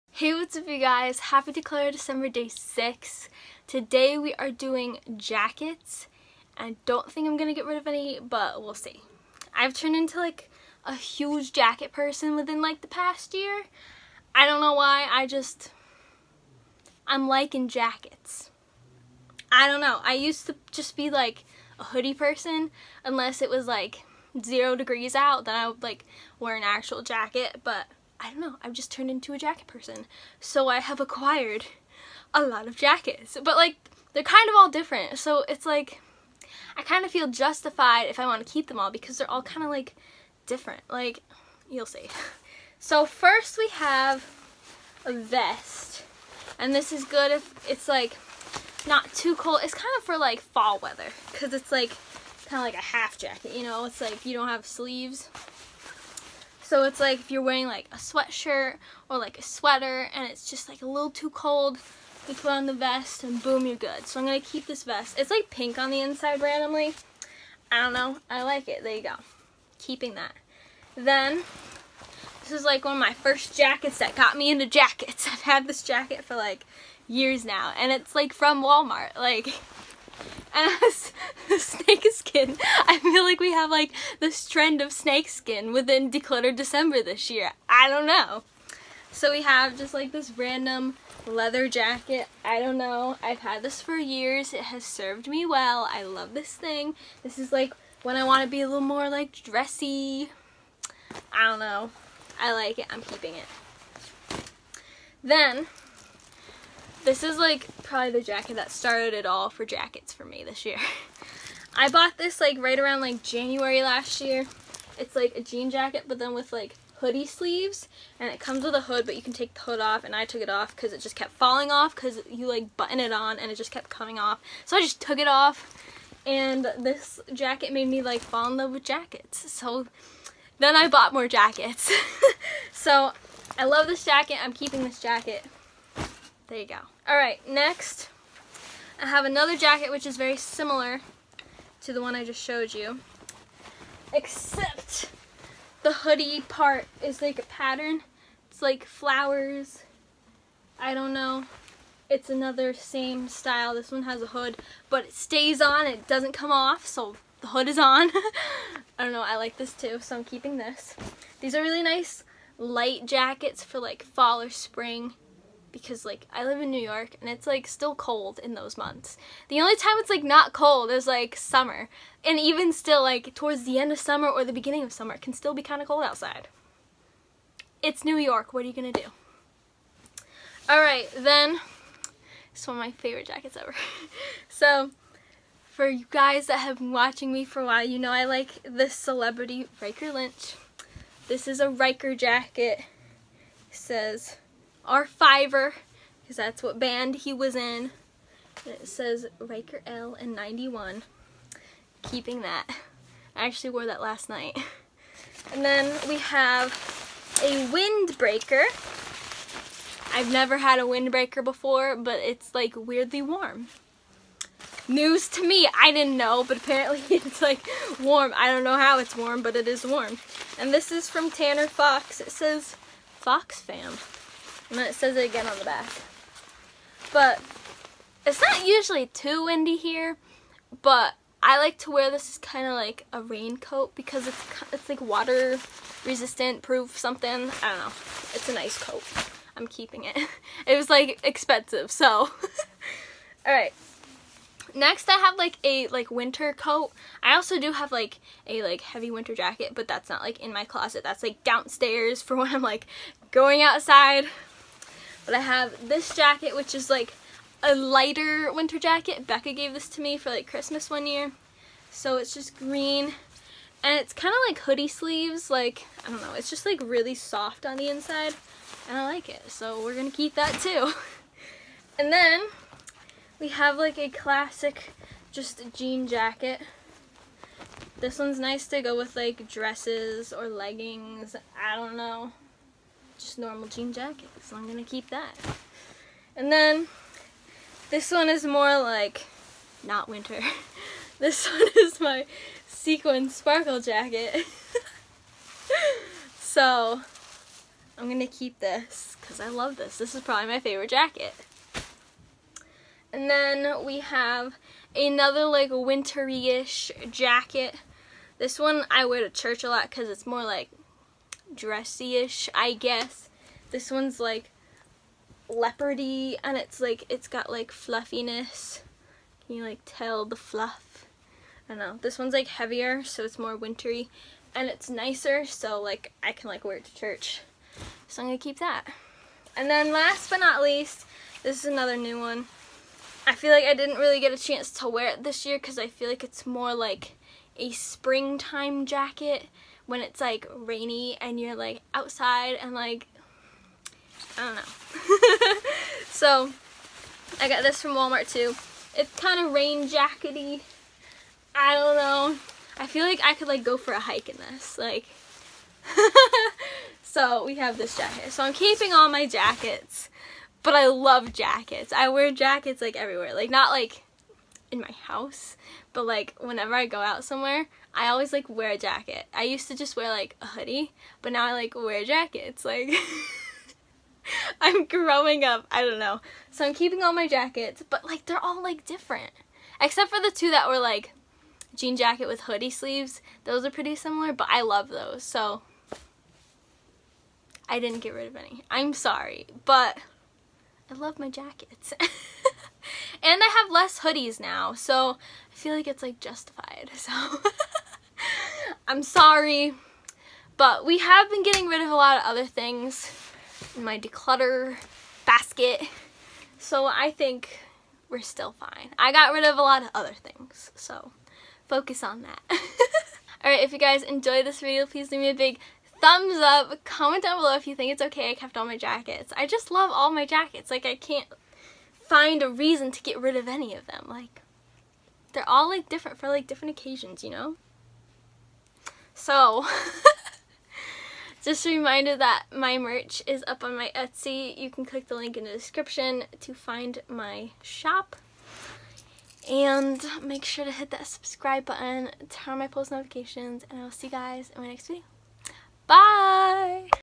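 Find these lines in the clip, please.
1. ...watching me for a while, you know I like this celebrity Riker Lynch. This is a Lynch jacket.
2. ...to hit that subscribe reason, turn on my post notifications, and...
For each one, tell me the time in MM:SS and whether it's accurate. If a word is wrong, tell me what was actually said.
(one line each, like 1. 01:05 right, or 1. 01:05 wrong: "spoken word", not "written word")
1. 03:06 wrong: "Riker", not "Lynch"
2. 07:20 wrong: "button", not "reason".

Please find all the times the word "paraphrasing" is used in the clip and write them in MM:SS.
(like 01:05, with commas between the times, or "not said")
not said.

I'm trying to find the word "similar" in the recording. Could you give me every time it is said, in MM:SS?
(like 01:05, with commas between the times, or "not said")
02:20, 06:23.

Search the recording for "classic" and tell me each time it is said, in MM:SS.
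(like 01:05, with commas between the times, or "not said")
04:34.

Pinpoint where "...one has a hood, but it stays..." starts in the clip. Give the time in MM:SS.
02:33.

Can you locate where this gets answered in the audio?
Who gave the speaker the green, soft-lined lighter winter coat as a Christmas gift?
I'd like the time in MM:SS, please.
04:19.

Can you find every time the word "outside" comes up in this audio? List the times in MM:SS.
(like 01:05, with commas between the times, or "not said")
02:56, 04:13, 05:41.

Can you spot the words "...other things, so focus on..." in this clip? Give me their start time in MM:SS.
06:49.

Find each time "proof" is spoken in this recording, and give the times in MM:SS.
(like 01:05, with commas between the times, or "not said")
03:56.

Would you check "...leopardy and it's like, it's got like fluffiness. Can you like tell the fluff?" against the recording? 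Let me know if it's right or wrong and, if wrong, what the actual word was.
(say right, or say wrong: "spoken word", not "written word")
right.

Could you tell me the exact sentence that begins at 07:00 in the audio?
Like, I can't find a reason to get rid of any of them.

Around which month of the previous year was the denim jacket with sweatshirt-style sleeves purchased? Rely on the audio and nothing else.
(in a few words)
January.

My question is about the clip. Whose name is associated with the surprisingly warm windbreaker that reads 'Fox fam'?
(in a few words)
Tanner Fox.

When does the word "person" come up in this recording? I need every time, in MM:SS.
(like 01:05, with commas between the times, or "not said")
00:11, 00:22, 00:29.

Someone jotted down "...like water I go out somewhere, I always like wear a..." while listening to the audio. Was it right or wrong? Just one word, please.
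wrong.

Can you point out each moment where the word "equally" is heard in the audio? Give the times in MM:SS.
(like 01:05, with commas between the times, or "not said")
not said.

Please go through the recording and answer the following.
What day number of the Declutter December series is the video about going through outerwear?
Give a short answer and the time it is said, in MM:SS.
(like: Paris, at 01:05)
6, at 00:02.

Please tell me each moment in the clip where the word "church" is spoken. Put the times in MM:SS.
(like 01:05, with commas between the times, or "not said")
05:09, 05:26.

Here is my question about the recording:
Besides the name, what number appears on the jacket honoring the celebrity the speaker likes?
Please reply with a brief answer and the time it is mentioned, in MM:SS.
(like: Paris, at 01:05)
91, at 03:20.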